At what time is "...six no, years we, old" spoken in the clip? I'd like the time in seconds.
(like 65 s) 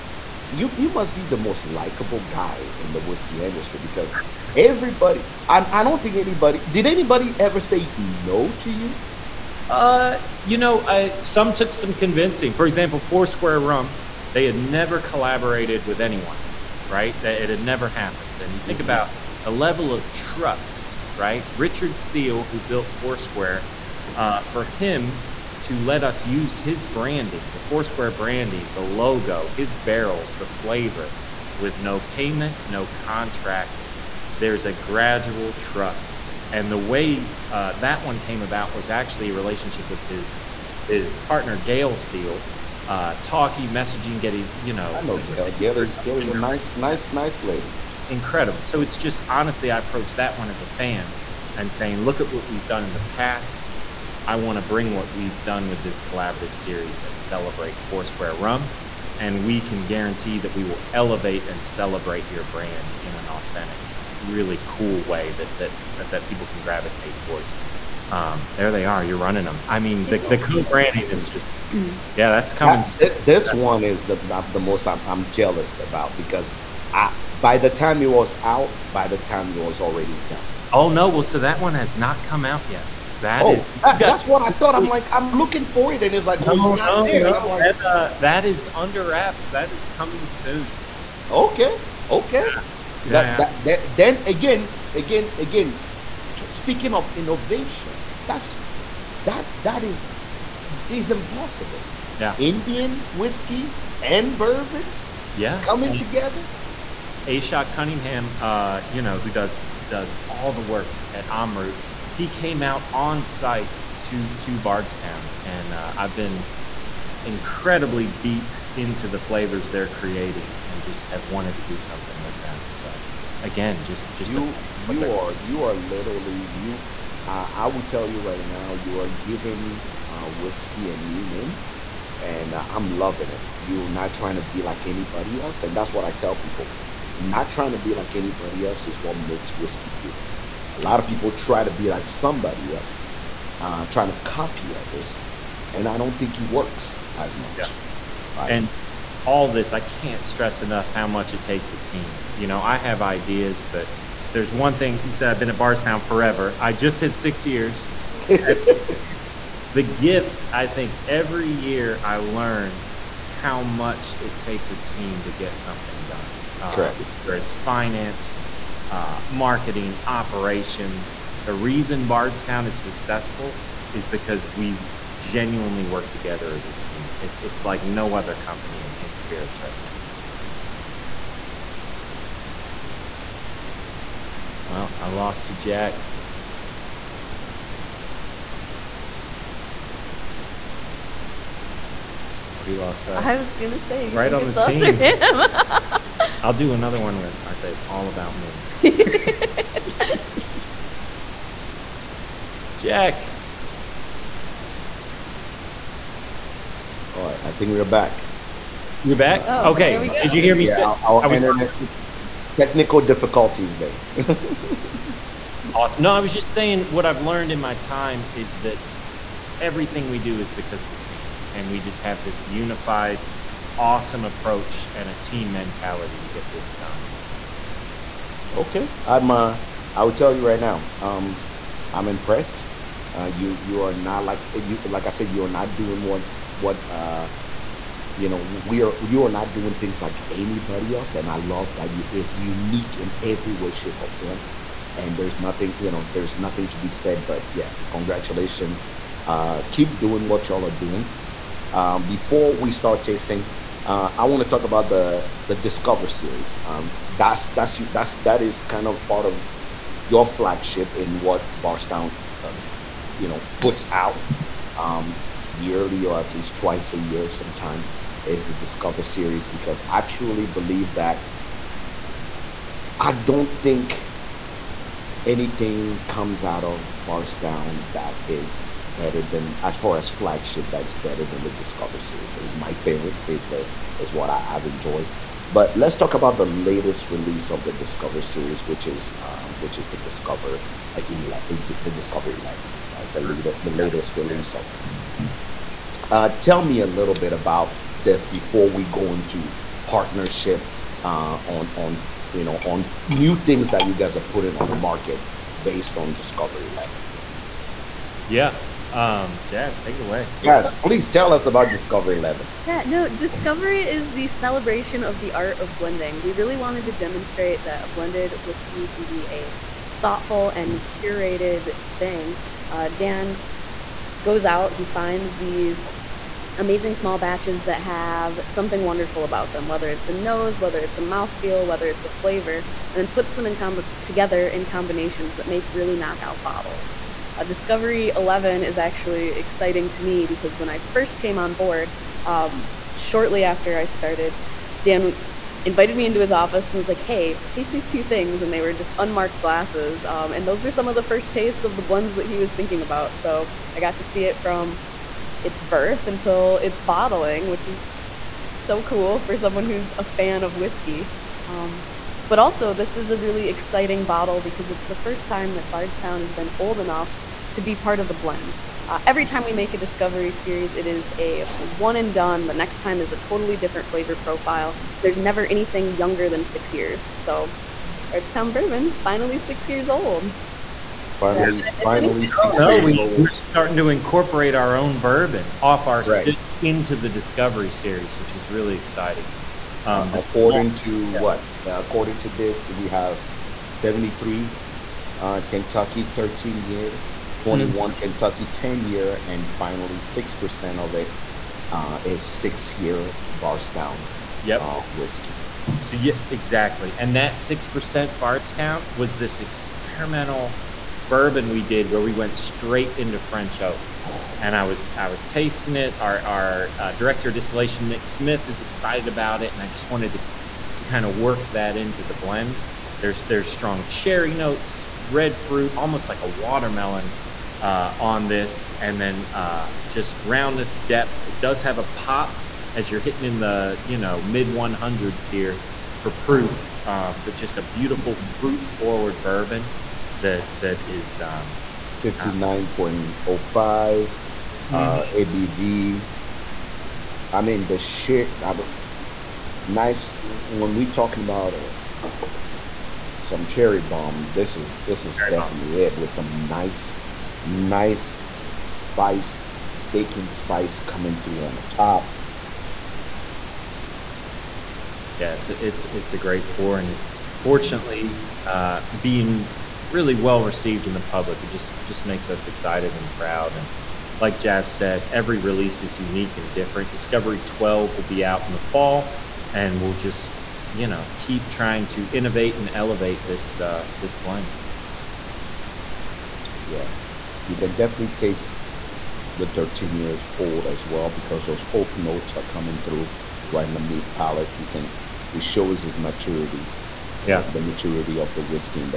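382 s.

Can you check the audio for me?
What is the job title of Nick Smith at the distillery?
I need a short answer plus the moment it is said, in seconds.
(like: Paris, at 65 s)
director of distillation, at 416 s.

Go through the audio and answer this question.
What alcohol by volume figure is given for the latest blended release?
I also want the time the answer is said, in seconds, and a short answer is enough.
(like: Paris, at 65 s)
59.05%, at 442 s.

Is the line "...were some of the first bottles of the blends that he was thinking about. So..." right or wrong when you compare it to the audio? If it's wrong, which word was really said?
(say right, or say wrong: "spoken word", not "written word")
wrong: "tastes", not "bottles".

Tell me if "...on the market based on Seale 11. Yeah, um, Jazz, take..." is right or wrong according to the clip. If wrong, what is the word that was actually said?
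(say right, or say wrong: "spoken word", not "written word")
wrong: "Discovery", not "Seale".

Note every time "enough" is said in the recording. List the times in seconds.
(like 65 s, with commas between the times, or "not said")
150 s, 366 s.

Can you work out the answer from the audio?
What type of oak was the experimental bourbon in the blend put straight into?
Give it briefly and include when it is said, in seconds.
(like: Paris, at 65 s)
French oak, at 413 s.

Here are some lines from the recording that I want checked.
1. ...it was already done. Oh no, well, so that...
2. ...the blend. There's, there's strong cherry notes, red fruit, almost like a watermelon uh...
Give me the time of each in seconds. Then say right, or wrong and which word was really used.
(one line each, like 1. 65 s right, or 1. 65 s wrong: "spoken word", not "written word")
1. 79 s right
2. 422 s right.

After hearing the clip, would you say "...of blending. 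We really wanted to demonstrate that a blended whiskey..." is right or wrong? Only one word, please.
right.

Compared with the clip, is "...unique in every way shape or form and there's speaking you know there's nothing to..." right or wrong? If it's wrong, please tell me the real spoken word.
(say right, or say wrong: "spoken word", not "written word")
wrong: "nothing", not "speaking".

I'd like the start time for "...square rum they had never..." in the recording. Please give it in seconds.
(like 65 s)
13 s.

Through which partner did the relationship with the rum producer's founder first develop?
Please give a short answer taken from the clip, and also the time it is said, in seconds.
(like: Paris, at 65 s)
Gail Seale, at 41 s.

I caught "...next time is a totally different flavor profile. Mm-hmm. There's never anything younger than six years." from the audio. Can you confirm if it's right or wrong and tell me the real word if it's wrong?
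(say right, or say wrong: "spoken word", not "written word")
right.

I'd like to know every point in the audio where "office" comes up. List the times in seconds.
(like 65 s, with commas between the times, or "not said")
346 s.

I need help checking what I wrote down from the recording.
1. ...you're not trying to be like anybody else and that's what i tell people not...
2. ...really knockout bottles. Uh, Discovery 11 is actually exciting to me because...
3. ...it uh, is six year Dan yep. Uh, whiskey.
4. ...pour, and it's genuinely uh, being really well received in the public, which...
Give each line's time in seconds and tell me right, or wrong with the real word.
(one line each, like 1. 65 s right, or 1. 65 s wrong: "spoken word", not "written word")
1. 133 s right
2. 335 s right
3. 400 s wrong: "Bardstown", not "Dan"
4. 466 s wrong: "fortunately", not "genuinely".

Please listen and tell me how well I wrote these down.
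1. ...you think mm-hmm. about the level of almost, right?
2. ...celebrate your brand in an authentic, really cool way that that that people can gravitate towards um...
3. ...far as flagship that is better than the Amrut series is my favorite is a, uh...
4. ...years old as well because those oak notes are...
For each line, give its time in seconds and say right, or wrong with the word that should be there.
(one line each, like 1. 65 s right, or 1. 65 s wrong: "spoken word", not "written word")
1. 18 s wrong: "trust", not "almost"
2. 61 s right
3. 279 s wrong: "Discover", not "Amrut"
4. 489 s right.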